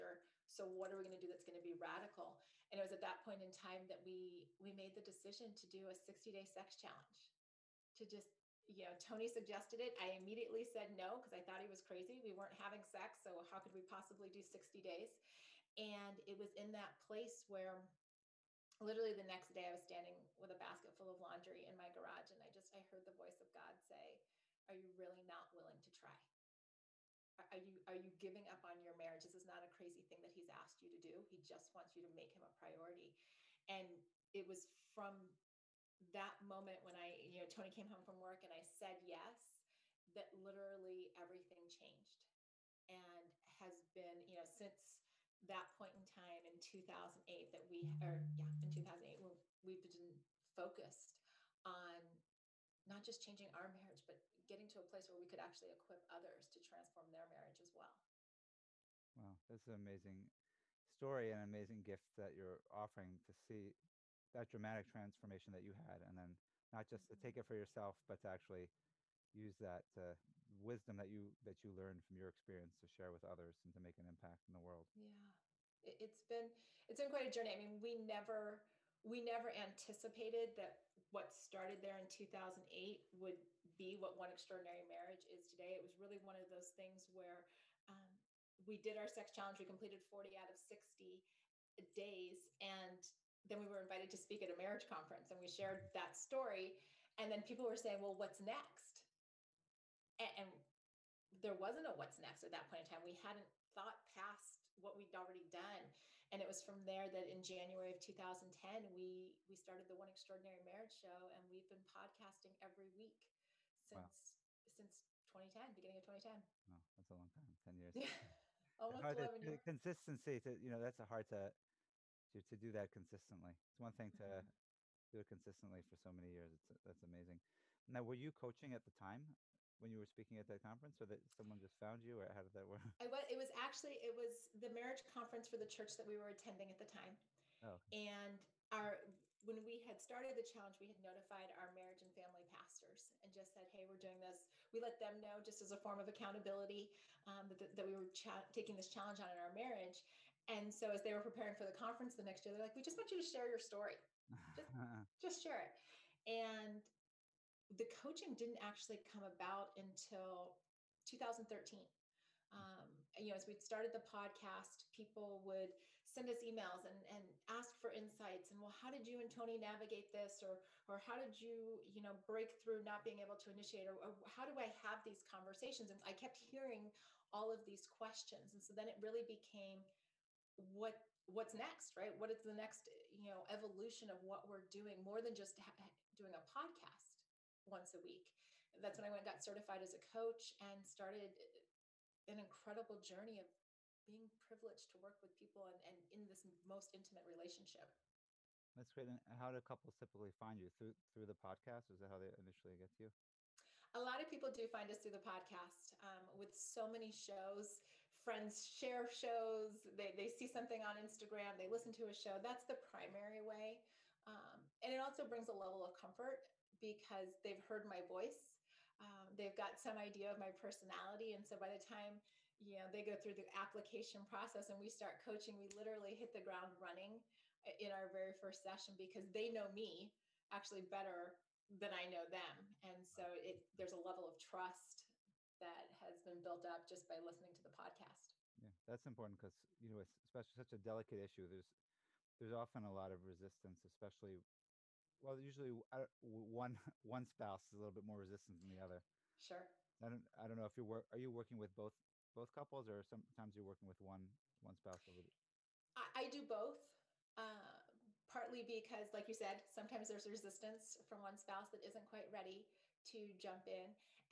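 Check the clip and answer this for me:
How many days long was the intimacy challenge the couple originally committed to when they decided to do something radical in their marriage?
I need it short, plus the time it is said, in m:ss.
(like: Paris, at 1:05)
60, at 0:05.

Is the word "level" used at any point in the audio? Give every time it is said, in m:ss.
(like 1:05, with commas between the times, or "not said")
3:35, 3:53.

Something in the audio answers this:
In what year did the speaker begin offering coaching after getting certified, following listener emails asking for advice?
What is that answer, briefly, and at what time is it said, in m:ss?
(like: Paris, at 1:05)
2013, at 2:41.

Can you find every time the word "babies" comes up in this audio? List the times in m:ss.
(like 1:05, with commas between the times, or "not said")
not said.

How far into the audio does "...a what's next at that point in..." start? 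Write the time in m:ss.
1:41.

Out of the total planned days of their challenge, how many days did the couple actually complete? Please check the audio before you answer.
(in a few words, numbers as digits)
40.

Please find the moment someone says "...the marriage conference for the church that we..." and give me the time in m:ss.
2:14.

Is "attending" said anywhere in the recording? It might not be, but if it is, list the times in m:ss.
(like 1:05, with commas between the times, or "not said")
2:16.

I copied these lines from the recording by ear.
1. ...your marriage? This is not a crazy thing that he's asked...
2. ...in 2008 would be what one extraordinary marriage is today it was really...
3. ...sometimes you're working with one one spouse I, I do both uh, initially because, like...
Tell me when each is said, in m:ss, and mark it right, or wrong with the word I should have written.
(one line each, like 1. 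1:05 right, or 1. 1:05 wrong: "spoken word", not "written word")
1. 0:28 right
2. 1:21 right
3. 4:13 wrong: "partly", not "initially".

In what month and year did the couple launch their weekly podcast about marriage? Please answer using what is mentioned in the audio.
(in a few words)
January 2010.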